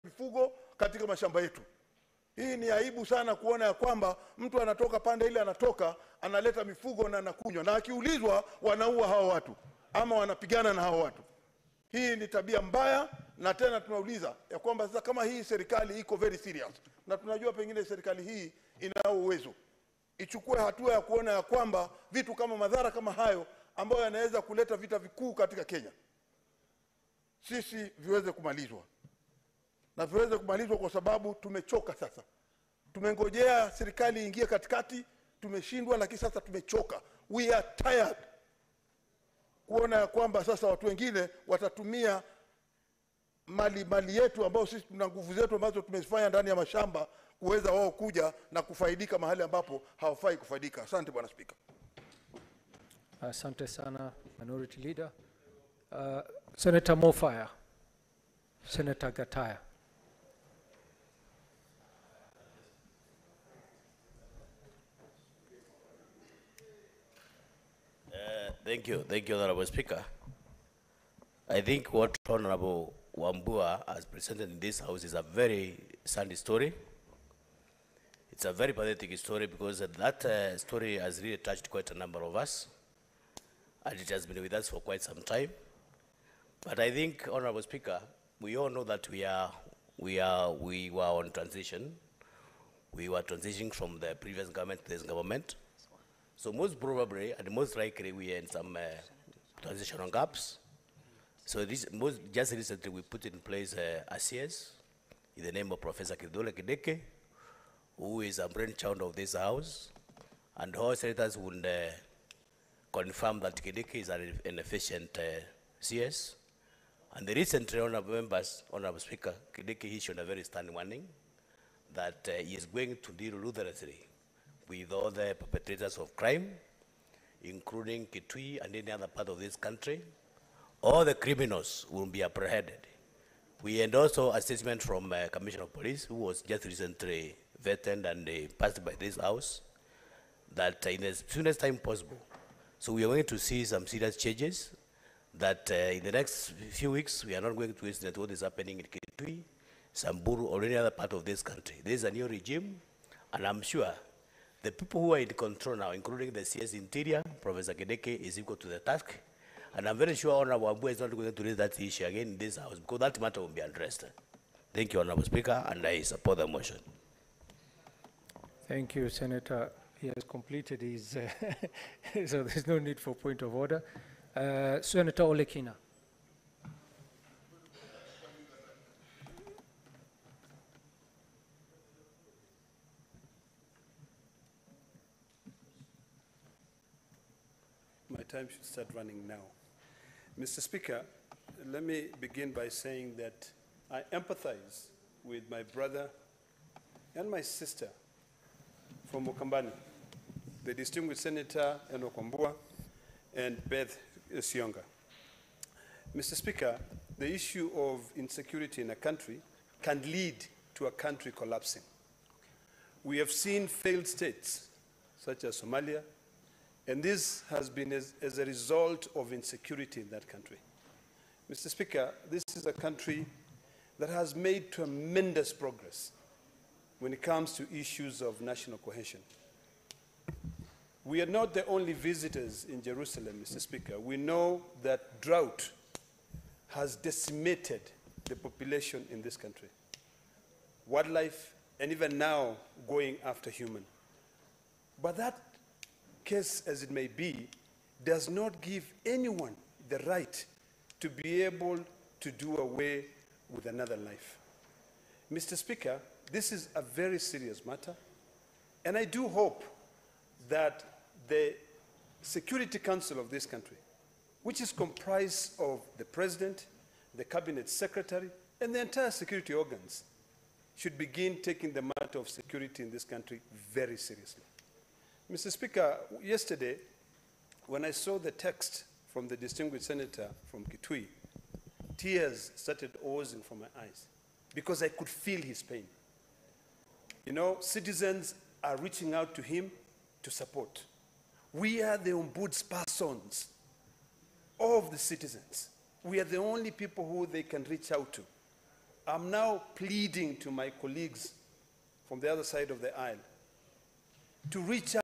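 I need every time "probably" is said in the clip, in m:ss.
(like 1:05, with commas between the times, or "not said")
1:36.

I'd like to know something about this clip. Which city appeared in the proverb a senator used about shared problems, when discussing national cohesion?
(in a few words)
Jerusalem.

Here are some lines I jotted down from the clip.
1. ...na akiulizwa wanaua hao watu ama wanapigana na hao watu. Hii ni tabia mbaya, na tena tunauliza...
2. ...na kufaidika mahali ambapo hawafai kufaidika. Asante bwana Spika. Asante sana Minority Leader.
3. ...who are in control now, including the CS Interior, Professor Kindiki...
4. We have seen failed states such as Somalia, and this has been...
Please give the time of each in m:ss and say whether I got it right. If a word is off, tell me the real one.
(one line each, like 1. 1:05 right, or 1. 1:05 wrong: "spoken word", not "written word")
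1. 0:07 right
2. 0:48 right
3. 2:35 right
4. 3:33 right.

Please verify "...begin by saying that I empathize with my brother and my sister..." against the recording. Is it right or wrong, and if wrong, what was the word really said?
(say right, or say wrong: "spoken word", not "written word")
right.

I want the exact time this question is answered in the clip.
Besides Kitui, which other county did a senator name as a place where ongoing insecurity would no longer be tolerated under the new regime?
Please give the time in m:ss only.
2:29.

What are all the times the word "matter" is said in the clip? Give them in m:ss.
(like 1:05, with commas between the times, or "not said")
2:43, 4:17, 4:31.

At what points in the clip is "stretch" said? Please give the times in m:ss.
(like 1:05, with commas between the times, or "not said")
not said.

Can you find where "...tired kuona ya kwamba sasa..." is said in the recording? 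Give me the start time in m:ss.
0:37.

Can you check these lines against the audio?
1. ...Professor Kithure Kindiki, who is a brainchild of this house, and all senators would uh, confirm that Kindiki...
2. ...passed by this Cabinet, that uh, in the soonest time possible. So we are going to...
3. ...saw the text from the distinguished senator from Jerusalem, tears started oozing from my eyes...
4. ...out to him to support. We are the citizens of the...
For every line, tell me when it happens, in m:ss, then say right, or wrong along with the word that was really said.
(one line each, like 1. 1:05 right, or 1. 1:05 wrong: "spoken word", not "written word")
1. 1:45 right
2. 2:18 wrong: "House", not "Cabinet"
3. 4:37 wrong: "Kitui", not "Jerusalem"
4. 4:49 wrong: "ombudspersons", not "citizens".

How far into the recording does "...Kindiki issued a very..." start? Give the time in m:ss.
1:59.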